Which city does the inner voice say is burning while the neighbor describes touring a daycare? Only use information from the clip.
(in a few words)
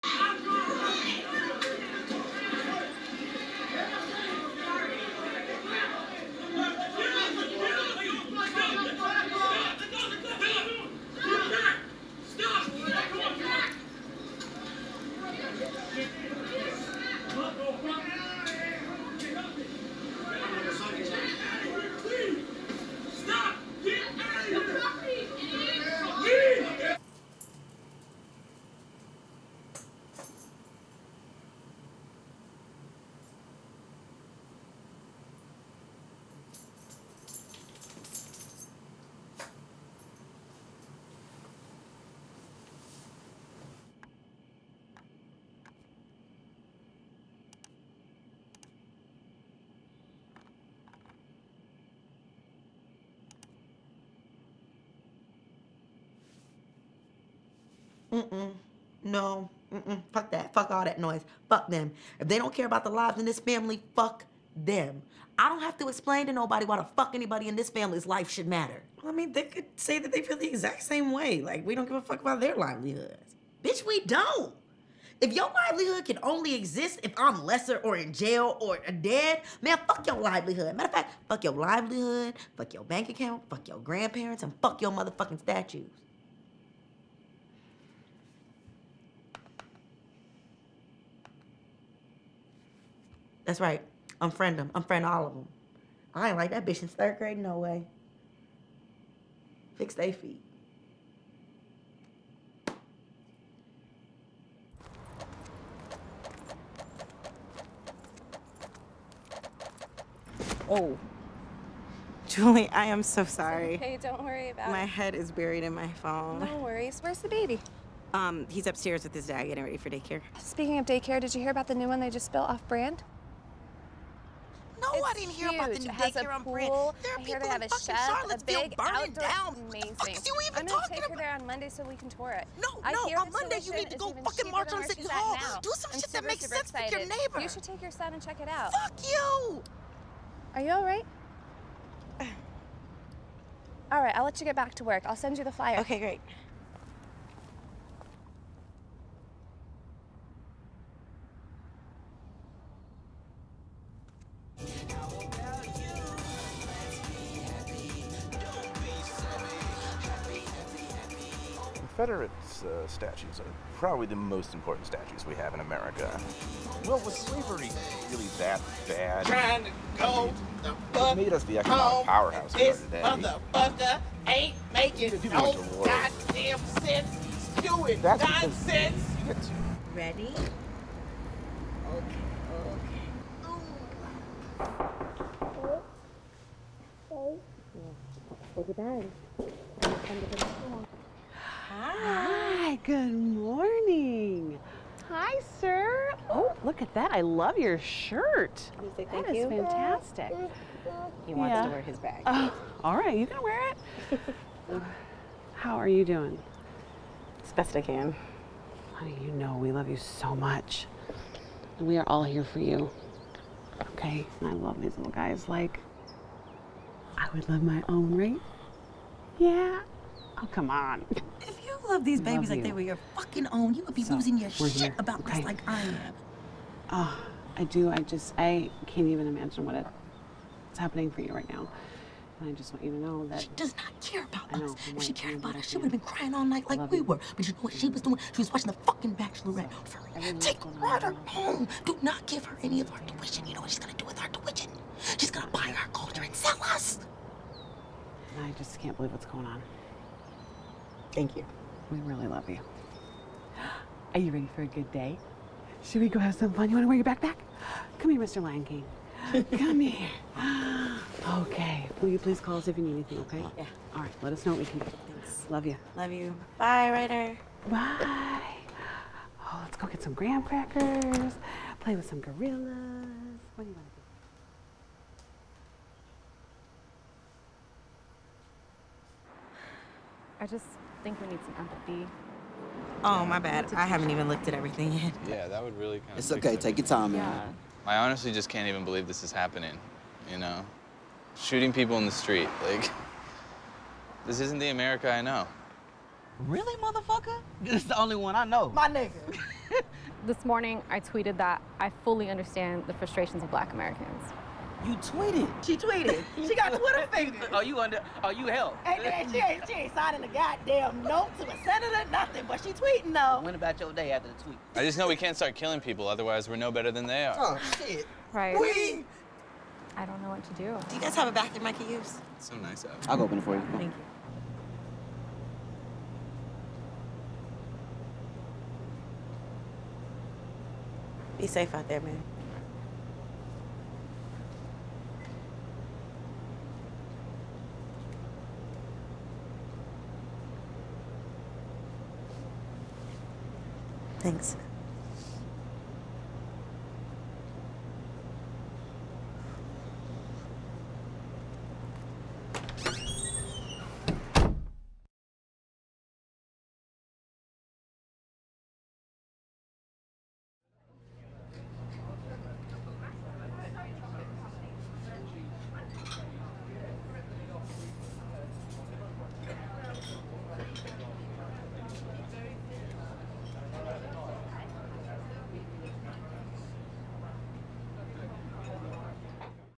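Charlottesville.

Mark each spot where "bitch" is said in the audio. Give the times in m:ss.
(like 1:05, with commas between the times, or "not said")
1:13, 1:36.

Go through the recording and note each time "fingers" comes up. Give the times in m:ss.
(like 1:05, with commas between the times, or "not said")
5:07.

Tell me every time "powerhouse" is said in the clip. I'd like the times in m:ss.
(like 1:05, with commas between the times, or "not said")
2:52.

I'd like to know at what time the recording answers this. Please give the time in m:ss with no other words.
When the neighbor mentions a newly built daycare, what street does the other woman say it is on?
2:06.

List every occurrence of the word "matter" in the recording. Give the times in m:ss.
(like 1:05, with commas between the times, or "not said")
1:08, 1:20.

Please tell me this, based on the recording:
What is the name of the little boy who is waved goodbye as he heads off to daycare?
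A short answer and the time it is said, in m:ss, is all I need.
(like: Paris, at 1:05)
Ryder, at 4:26.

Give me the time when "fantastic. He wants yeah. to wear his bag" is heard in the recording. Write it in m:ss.
3:19.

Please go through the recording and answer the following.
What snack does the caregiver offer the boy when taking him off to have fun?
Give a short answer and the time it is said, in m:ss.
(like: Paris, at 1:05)
Graham crackers, at 4:30.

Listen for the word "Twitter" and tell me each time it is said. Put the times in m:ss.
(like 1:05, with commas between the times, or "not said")
5:06.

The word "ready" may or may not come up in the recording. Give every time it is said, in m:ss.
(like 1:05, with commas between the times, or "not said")
1:59, 2:59, 4:14.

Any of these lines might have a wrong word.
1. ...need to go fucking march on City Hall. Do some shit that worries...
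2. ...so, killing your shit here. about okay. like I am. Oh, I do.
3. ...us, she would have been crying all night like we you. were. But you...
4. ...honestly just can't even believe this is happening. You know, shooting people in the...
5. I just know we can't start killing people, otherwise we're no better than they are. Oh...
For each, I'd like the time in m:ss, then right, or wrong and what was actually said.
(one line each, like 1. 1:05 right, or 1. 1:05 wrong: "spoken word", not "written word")
1. 2:13 wrong: "makes", not "worries"
2. 3:44 wrong: "losing", not "killing"
3. 3:55 right
4. 4:47 right
5. 5:14 right.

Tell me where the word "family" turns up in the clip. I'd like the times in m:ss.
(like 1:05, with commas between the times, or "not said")
1:03, 1:07.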